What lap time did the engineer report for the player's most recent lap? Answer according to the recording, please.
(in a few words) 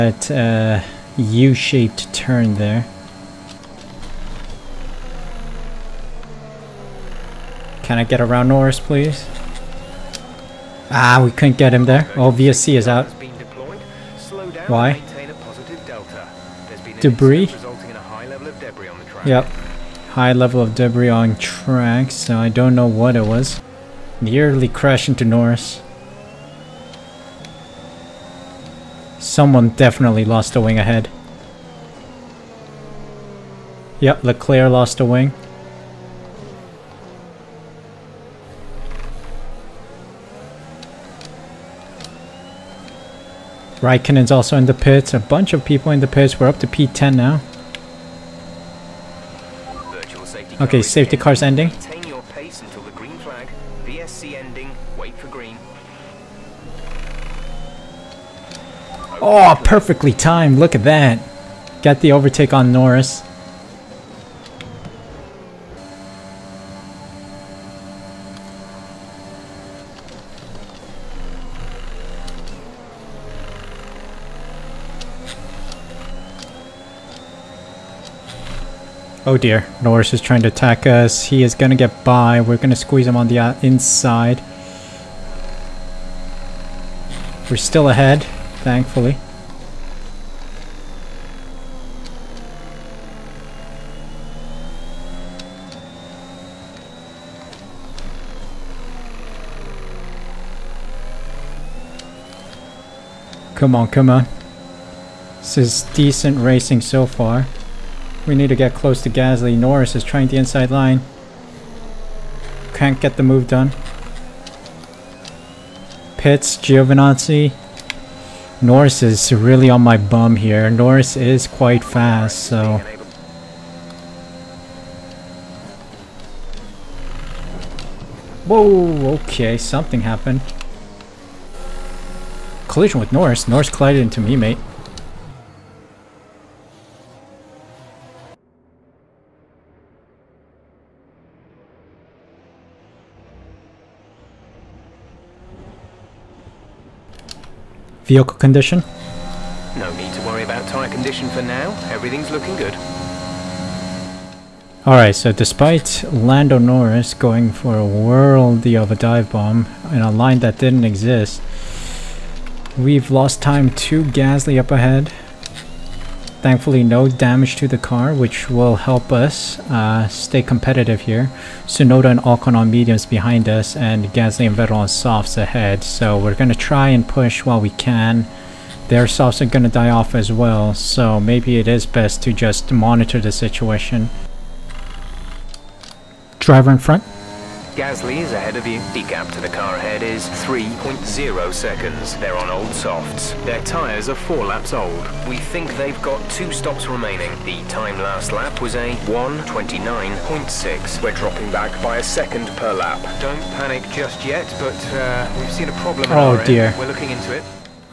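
1:29.6.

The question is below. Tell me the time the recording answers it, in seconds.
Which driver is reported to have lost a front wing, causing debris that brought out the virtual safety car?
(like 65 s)
34 s.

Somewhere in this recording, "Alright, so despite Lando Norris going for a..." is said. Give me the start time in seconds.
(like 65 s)
154 s.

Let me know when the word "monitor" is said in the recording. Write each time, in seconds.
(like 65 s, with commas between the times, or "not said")
182 s.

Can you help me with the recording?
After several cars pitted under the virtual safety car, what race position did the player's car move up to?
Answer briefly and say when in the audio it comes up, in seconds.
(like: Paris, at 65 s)
P10, at 46 s.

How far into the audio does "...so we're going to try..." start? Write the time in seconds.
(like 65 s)
175 s.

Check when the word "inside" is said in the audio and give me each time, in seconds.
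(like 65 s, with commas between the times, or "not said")
83 s, 110 s.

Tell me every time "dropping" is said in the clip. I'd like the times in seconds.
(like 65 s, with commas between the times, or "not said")
201 s.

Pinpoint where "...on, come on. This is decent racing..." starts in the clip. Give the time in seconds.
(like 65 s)
103 s.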